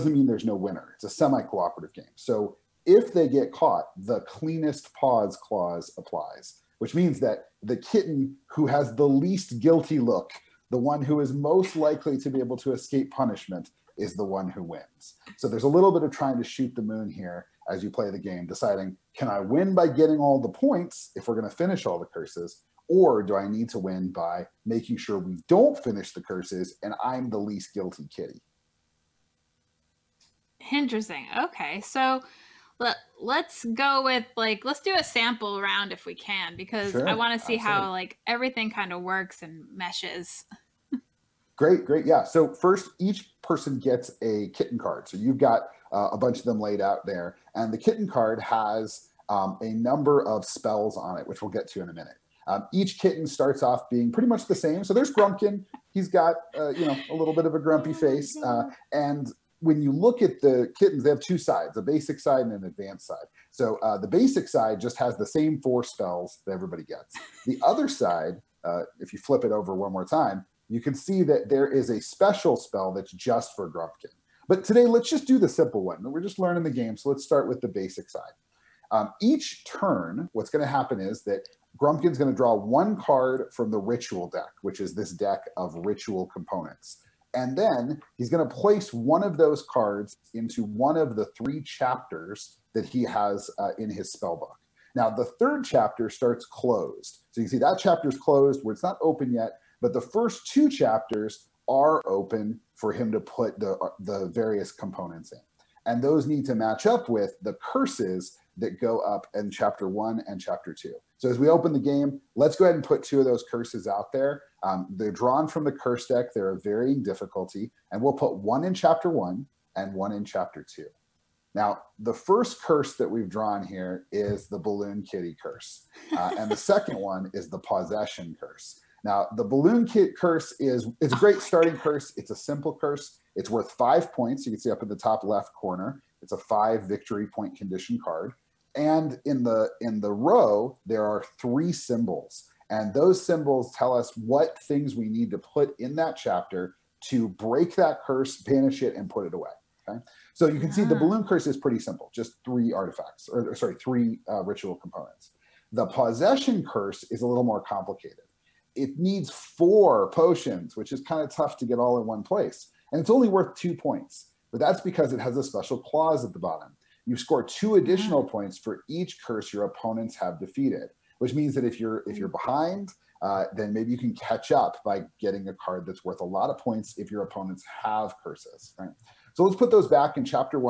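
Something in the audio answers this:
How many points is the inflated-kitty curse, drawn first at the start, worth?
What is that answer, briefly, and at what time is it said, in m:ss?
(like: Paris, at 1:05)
5, at 2:13.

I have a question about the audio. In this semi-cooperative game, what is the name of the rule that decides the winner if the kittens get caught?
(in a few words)
Cleanest paws clause.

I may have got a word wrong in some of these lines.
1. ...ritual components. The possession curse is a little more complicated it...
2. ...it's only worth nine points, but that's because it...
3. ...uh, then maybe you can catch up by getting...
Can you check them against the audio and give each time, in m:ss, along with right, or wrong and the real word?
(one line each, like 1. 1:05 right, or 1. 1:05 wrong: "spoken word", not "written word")
1. 2:34 right
2. 2:42 wrong: "two", not "nine"
3. 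2:53 right.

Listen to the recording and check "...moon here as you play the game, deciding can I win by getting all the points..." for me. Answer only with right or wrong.
right.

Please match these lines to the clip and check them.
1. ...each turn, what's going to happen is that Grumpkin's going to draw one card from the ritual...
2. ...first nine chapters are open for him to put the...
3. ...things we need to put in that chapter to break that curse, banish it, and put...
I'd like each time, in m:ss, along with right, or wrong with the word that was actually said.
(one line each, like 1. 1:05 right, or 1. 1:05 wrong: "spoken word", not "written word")
1. 1:19 right
2. 1:39 wrong: "two", not "nine"
3. 2:24 right.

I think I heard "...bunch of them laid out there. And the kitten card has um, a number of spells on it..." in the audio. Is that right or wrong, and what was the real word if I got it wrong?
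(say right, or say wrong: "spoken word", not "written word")
right.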